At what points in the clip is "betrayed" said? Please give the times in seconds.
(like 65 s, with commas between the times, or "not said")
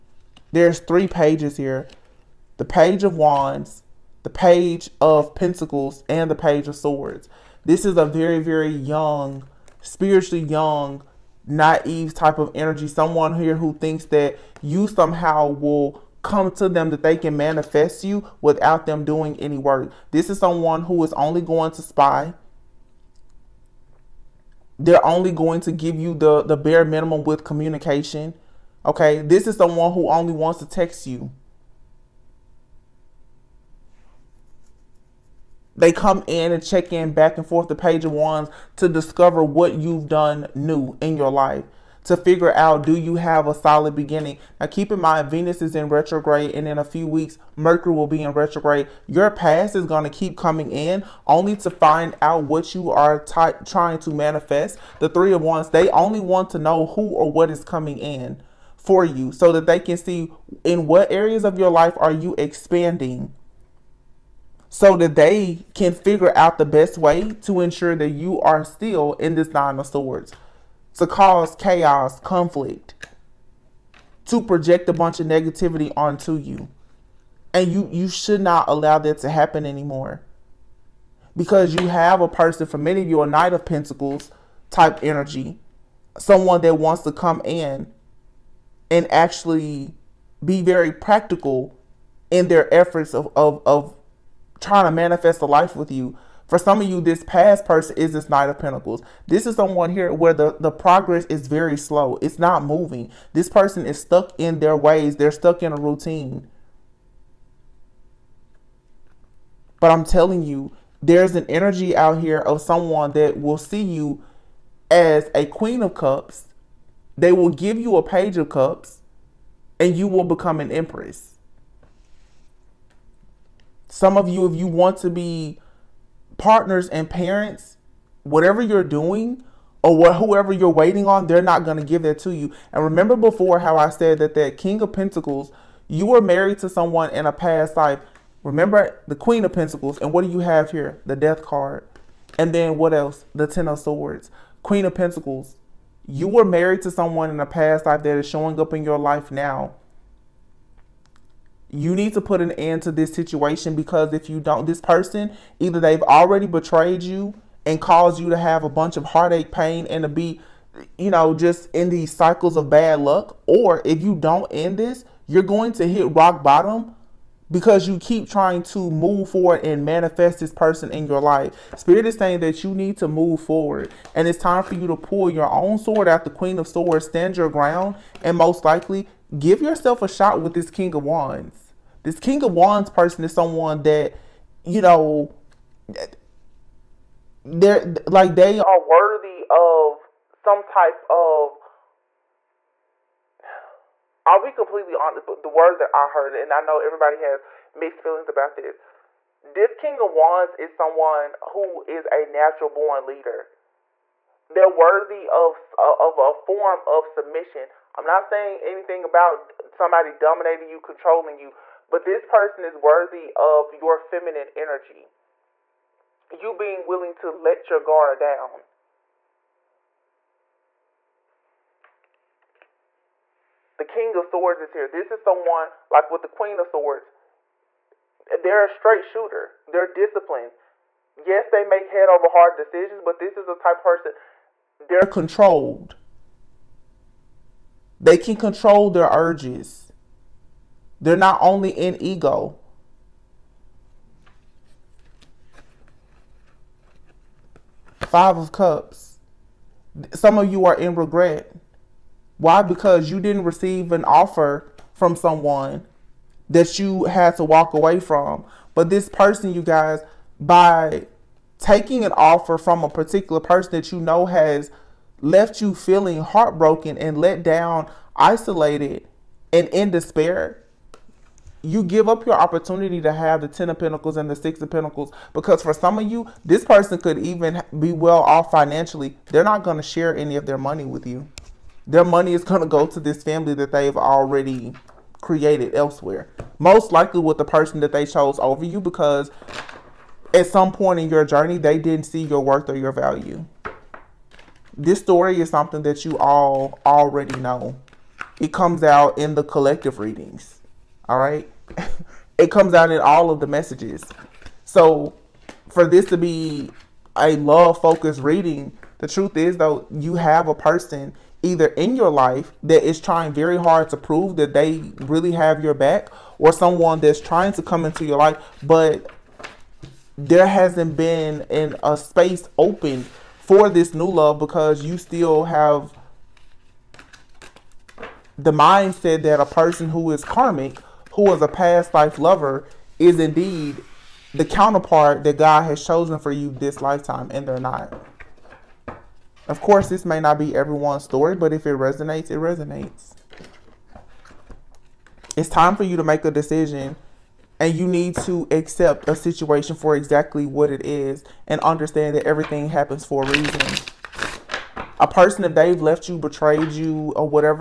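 156 s, 356 s.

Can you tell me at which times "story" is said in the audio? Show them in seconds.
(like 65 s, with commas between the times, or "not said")
294 s, 341 s.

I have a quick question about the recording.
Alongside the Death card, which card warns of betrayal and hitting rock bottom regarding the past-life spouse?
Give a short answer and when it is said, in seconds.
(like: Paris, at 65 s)
Ten of Swords, at 143 s.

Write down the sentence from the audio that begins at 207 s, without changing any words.
I'm not saying anything about somebody dominating you, controlling you, but this person is worthy of your feminine energy.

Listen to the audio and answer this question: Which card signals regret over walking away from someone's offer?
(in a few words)
Five of Cups.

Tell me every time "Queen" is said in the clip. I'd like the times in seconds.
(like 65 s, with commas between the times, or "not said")
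115 s, 139 s, 144 s, 176 s, 226 s.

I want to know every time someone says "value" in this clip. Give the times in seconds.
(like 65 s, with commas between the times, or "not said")
292 s.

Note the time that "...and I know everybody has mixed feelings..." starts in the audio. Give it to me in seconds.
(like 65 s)
196 s.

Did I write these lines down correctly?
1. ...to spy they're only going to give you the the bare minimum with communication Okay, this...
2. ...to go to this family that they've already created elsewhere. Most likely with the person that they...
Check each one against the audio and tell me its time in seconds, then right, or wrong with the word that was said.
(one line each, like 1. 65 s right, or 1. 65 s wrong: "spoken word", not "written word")
1. 21 s right
2. 282 s right.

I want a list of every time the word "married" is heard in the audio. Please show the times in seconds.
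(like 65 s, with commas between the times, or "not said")
136 s, 146 s.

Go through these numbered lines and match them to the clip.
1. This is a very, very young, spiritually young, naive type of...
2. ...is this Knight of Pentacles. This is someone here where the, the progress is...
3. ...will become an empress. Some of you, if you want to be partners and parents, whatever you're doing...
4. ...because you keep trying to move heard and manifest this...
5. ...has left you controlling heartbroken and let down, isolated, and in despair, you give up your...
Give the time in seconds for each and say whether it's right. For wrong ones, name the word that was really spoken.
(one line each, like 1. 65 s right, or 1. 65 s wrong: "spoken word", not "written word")
1. 7 s right
2. 97 s right
3. 120 s right
4. 167 s wrong: "forward", not "heard"
5. 264 s wrong: "feeling", not "controlling".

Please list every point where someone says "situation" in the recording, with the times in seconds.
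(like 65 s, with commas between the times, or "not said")
153 s, 349 s.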